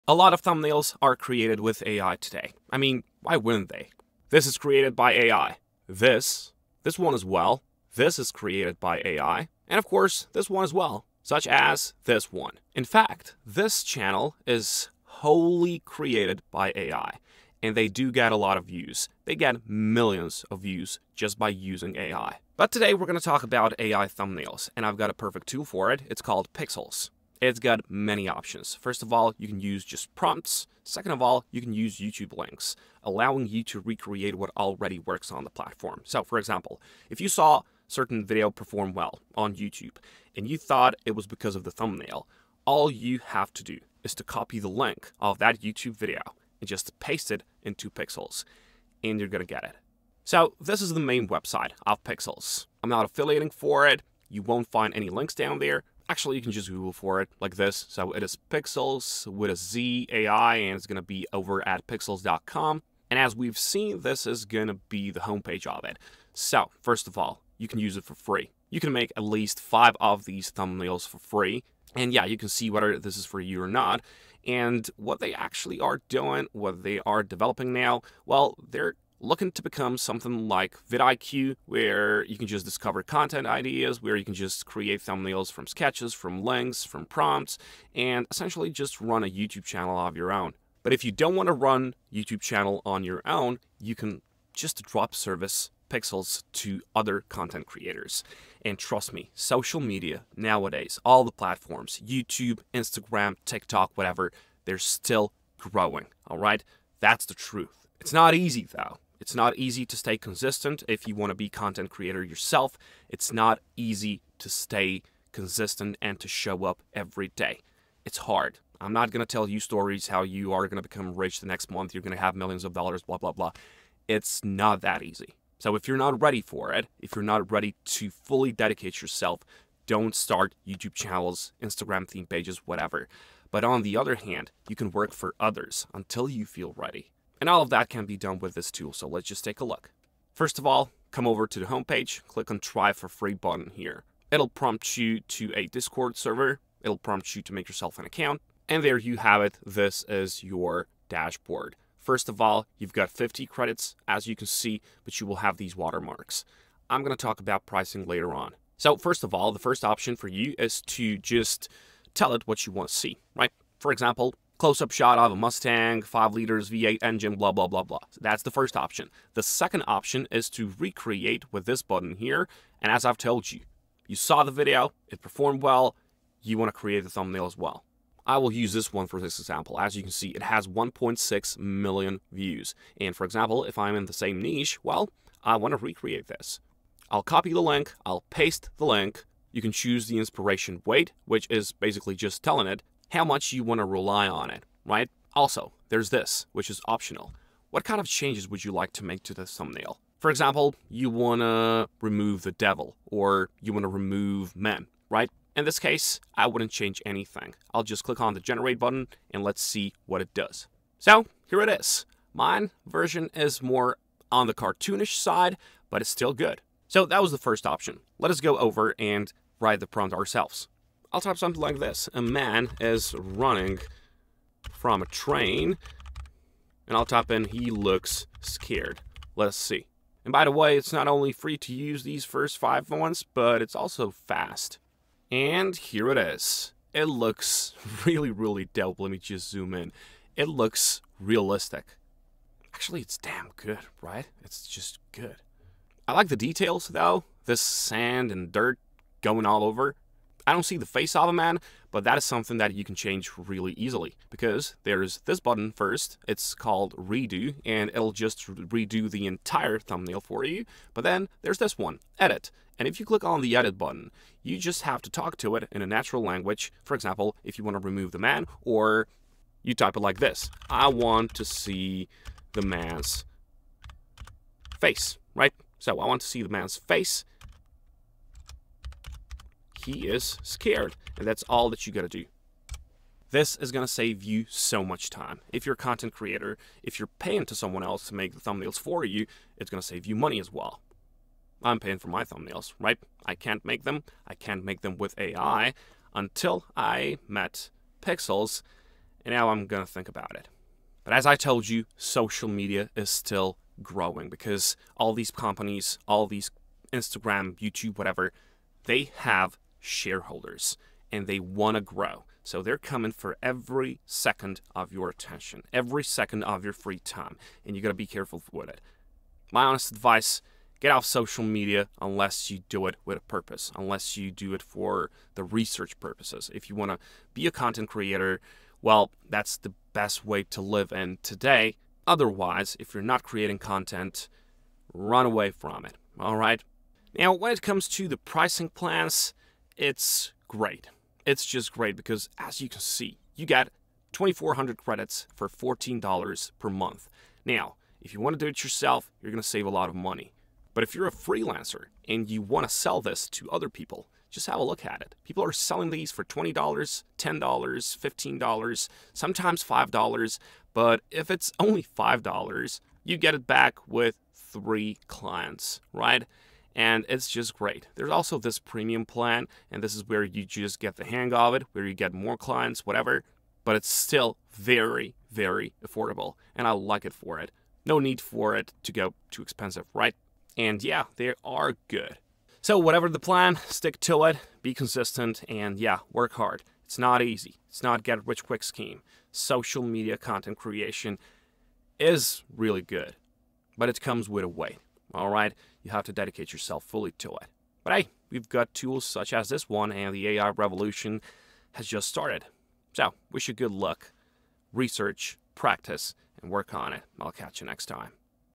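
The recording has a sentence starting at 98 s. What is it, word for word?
And trust me, social media nowadays, all the platforms, YouTube, Instagram, TikTok, whatever, they're still growing, all right?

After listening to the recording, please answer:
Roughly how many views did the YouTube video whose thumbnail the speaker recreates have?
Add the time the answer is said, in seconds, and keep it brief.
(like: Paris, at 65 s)
1.6 million, at 180 s.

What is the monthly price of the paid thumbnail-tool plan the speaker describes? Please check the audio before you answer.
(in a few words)
$14.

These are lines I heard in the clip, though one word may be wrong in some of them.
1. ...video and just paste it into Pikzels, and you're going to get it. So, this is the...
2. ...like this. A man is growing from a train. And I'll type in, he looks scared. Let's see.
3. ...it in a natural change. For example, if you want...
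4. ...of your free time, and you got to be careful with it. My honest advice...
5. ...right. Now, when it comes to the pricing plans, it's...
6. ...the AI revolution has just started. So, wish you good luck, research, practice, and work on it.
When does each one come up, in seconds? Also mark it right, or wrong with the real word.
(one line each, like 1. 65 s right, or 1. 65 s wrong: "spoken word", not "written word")
1. 45 s right
2. 221 s wrong: "running", not "growing"
3. 265 s wrong: "language", not "change"
4. 316 s right
5. 336 s right
6. 400 s right.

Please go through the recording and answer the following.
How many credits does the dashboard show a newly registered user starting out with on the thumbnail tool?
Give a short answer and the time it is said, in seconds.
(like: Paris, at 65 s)
50, at 153 s.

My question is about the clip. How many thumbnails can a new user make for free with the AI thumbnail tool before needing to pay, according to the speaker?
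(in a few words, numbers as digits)
5.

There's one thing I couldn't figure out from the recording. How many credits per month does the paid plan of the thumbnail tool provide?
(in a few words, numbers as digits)
2,400.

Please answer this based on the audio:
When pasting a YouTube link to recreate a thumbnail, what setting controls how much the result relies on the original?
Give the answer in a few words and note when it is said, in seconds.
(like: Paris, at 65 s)
inspiration weight, at 190 s.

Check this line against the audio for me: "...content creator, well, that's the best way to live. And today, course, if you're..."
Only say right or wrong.
wrong.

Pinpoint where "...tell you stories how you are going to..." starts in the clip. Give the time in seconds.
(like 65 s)
119 s.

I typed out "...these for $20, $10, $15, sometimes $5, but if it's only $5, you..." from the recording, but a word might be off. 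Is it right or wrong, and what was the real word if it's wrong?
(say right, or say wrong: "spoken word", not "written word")
right.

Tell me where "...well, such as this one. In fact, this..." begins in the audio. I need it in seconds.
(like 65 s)
10 s.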